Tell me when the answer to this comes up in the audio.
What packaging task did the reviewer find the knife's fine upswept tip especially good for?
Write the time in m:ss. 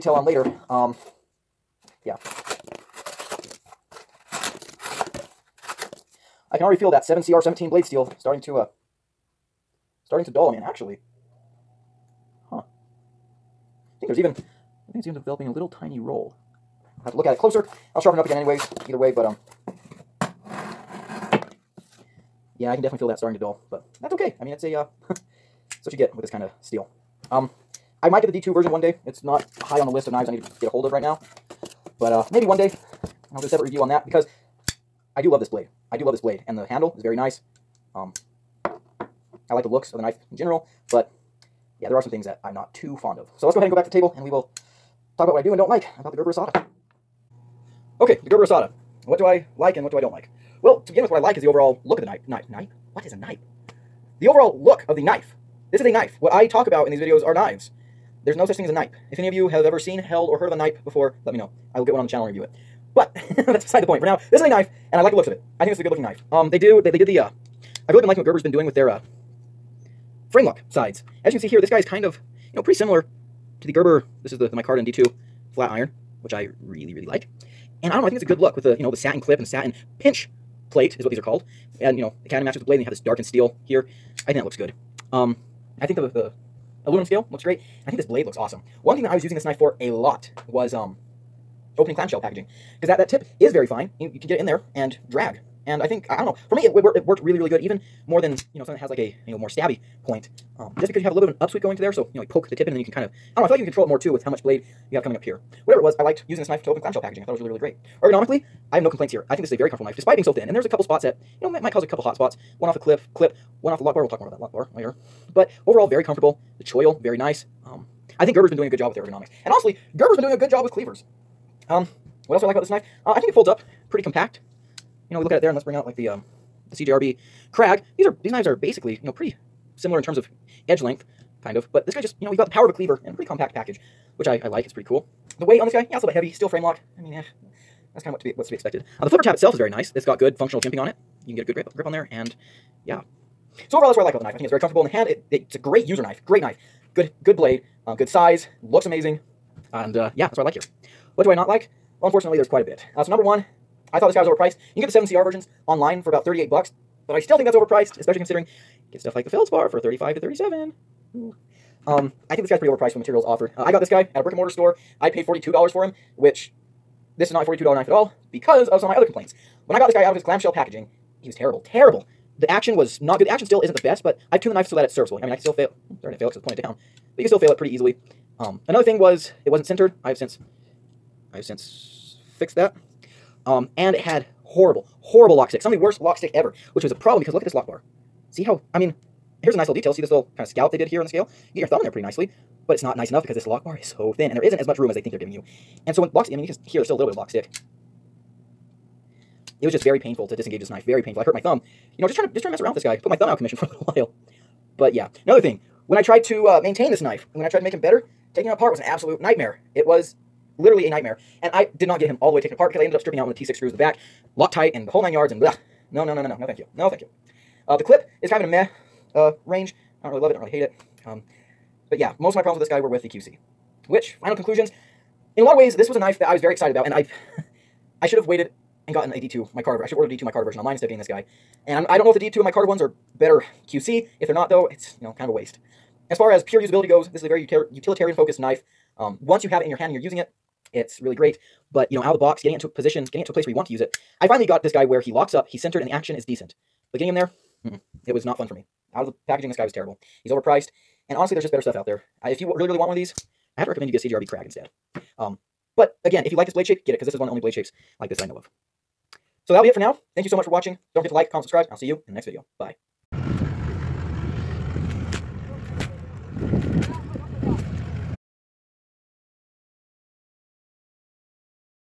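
1:31.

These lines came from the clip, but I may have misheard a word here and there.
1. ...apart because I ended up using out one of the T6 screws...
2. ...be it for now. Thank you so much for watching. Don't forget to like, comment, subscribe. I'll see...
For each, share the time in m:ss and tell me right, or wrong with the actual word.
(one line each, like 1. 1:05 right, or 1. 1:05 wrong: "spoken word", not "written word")
1. 3:32 wrong: "stripping", not "using"
2. 4:19 right.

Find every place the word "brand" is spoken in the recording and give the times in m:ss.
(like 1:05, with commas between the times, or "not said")
not said.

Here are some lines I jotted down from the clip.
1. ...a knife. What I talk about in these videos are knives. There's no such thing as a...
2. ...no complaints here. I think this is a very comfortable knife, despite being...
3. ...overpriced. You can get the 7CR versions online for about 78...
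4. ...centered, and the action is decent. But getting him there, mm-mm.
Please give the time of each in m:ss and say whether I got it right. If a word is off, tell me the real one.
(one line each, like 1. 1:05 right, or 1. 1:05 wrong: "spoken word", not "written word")
1. 0:55 right
2. 1:48 right
3. 2:34 wrong: "38", not "78"
4. 4:05 right.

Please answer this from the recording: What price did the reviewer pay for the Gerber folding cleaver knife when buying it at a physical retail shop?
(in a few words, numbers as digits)
$42.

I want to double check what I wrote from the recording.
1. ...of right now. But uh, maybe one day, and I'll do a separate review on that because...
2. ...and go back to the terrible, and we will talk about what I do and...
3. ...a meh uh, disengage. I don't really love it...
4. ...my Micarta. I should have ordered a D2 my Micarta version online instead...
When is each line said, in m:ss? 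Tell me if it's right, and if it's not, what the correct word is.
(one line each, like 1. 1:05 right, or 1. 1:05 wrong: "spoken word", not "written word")
1. 0:30 right
2. 0:43 wrong: "table", not "terrible"
3. 3:38 wrong: "range", not "disengage"
4. 3:49 right.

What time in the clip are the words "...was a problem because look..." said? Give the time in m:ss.
3:06.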